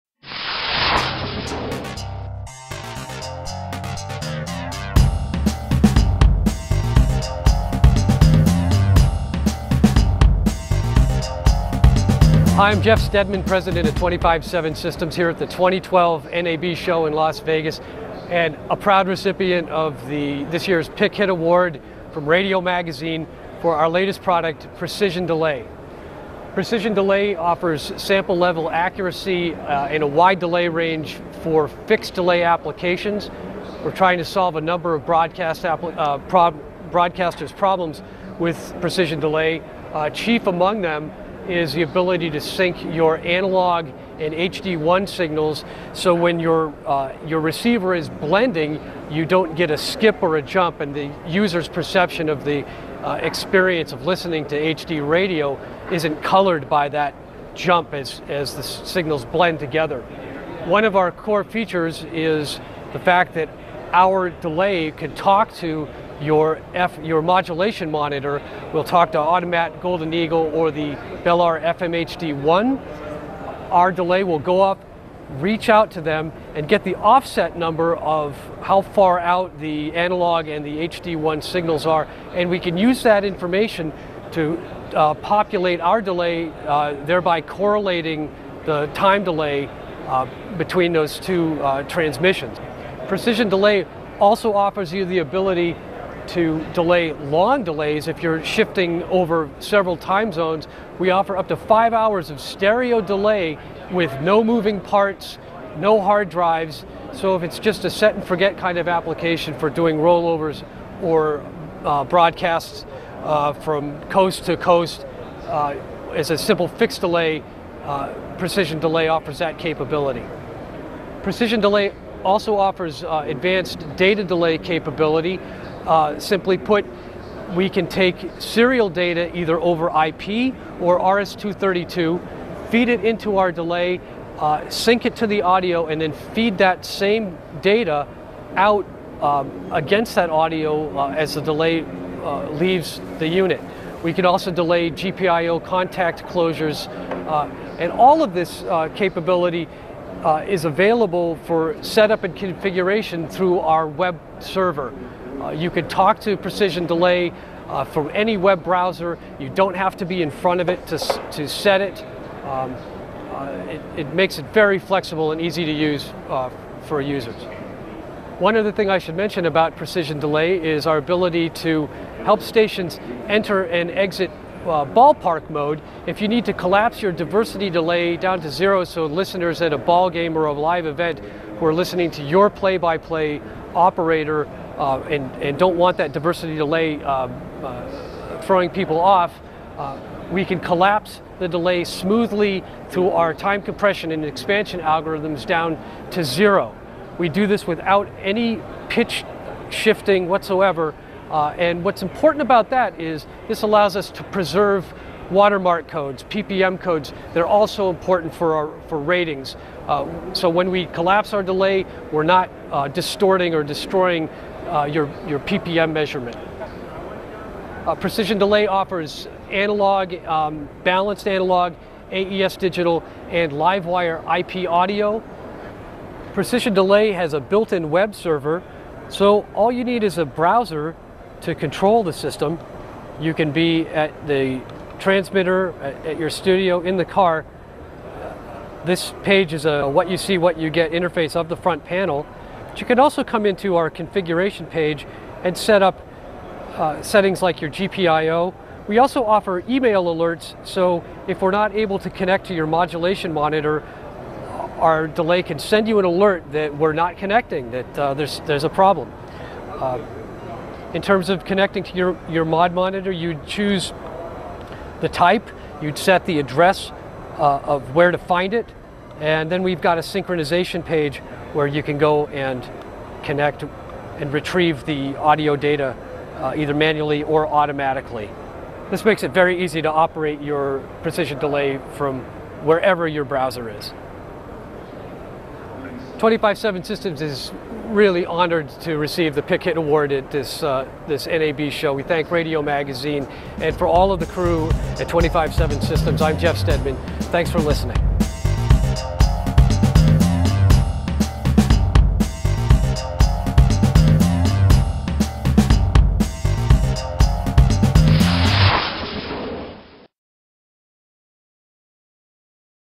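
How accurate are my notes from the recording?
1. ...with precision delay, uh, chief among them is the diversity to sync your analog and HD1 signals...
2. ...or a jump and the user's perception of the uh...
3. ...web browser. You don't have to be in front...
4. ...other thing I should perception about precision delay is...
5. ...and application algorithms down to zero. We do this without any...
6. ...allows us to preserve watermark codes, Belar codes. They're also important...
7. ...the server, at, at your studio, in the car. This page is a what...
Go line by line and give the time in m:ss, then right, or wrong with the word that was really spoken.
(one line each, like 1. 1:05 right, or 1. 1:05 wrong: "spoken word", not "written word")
1. 0:38 wrong: "ability", not "diversity"
2. 0:50 right
3. 2:38 right
4. 2:48 wrong: "mention", not "perception"
5. 3:14 wrong: "expansion", not "application"
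6. 3:23 wrong: "PPM", not "Belar"
7. 3:54 wrong: "transmitter", not "server".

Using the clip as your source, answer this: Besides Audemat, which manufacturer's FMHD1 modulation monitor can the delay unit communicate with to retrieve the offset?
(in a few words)
Belar.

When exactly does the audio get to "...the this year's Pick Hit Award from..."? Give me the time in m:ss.
0:20.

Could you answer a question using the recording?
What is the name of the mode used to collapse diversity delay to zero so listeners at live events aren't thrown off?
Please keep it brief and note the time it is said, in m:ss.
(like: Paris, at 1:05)
ballpark mode, at 2:54.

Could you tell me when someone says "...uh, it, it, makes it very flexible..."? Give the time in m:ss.
2:43.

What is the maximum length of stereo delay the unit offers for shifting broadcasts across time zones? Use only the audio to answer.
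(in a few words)
5 hours.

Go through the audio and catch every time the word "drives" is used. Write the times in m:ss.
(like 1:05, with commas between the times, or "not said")
1:46.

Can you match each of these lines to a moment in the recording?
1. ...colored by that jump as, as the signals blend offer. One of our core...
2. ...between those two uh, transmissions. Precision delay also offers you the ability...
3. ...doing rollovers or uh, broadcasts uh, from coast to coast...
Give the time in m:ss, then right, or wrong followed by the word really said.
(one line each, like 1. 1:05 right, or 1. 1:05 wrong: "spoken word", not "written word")
1. 0:56 wrong: "together", not "offer"
2. 1:30 right
3. 1:49 right.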